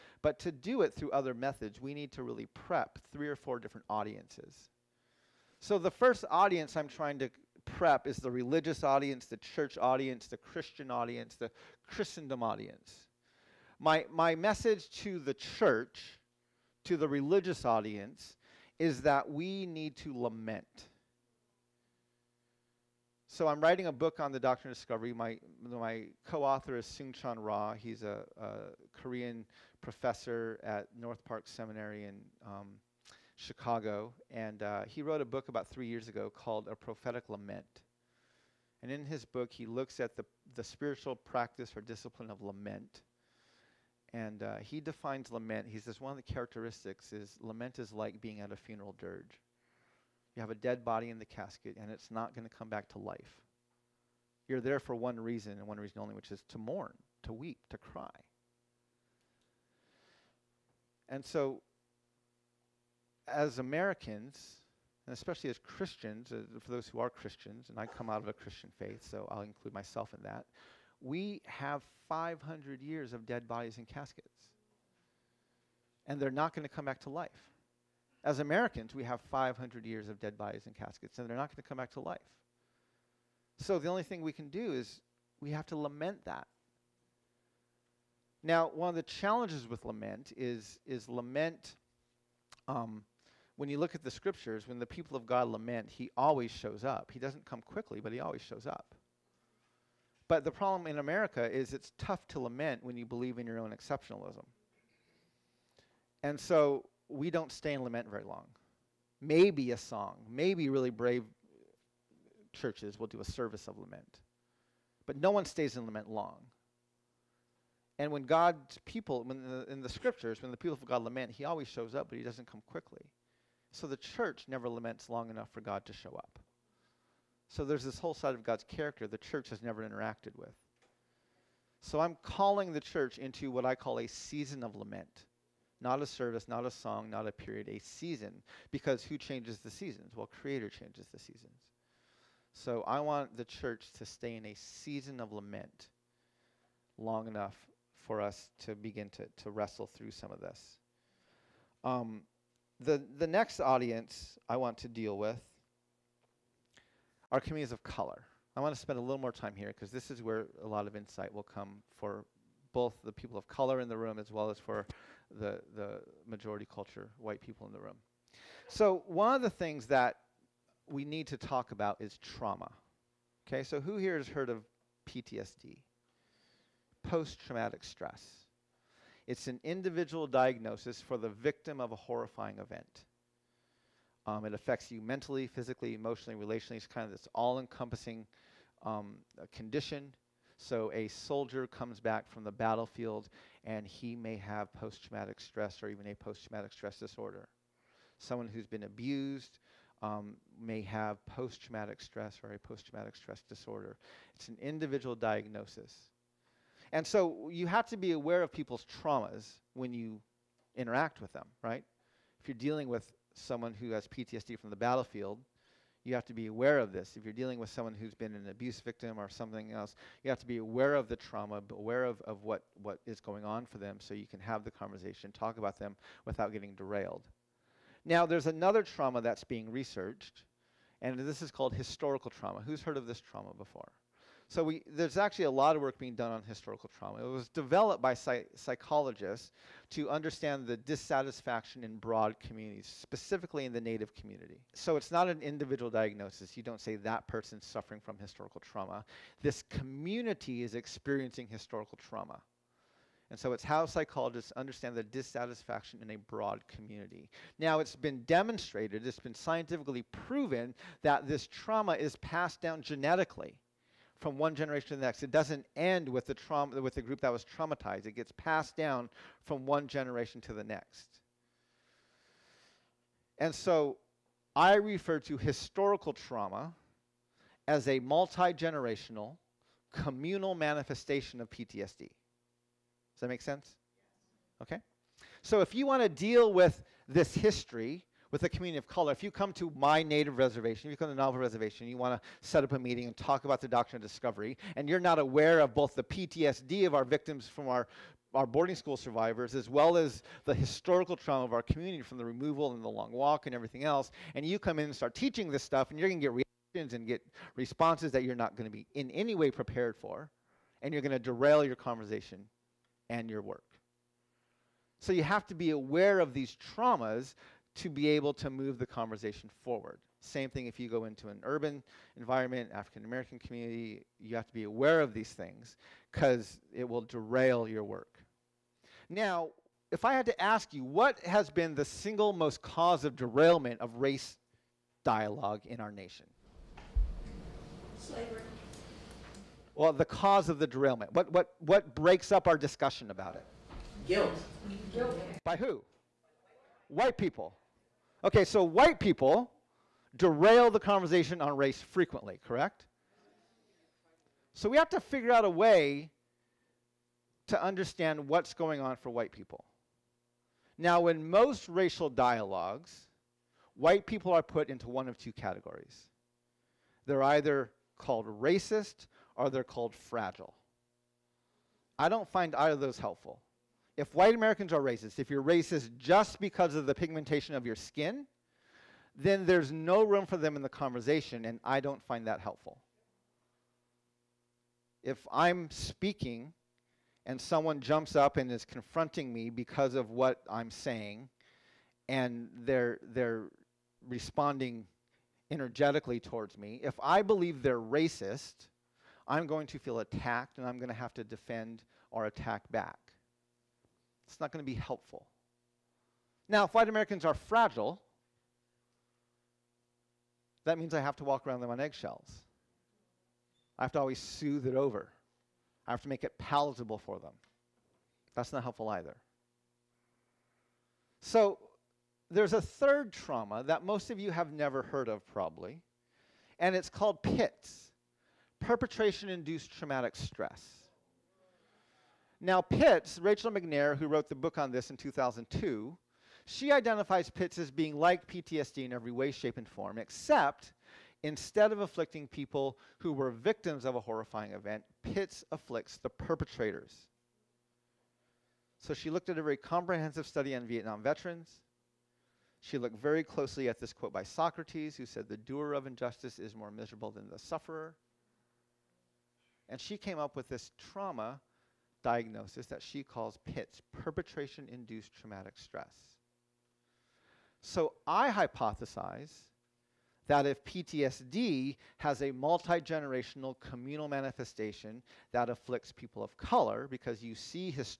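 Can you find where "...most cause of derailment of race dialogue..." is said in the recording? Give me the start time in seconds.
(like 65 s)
332 s.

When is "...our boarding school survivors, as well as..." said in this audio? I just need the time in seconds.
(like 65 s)
298 s.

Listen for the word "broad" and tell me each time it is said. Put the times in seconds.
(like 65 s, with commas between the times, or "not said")
241 s, 256 s.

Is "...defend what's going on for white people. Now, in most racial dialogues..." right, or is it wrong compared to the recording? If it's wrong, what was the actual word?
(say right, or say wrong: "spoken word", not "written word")
wrong: "understand", not "defend".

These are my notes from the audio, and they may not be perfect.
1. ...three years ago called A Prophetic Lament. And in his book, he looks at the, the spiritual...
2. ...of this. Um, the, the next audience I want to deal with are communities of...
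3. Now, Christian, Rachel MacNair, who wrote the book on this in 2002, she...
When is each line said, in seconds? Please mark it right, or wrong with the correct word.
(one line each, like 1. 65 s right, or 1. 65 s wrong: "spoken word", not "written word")
1. 35 s right
2. 150 s right
3. 432 s wrong: "PITS", not "Christian".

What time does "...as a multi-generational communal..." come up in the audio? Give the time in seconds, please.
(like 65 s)
277 s.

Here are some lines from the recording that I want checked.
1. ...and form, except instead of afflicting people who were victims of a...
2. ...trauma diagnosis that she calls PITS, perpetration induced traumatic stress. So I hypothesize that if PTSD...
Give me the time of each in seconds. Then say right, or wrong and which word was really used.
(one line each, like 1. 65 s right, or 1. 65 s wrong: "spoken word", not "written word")
1. 439 s right
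2. 460 s right.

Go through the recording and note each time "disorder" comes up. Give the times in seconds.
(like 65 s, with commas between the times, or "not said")
196 s, 203 s.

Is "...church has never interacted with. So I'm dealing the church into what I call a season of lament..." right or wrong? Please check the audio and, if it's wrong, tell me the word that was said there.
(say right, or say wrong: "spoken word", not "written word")
wrong: "calling", not "dealing".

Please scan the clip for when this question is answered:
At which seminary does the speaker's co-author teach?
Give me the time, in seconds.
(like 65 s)
30 s.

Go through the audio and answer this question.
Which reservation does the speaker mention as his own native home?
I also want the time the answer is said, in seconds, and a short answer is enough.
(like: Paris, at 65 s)
Navajo Reservation, at 291 s.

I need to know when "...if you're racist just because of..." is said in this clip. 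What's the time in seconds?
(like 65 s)
375 s.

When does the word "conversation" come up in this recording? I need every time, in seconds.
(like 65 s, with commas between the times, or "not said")
224 s, 311 s, 318 s, 350 s, 380 s.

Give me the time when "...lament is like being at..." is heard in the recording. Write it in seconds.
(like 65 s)
47 s.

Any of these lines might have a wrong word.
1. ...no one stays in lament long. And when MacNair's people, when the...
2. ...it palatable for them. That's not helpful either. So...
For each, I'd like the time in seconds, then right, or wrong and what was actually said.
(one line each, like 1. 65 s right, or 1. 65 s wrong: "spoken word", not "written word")
1. 115 s wrong: "God", not "MacNair"
2. 416 s right.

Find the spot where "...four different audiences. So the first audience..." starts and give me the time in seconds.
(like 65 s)
3 s.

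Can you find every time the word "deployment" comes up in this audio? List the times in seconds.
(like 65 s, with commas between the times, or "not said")
not said.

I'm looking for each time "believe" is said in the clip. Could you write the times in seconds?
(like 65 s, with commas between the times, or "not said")
103 s, 397 s.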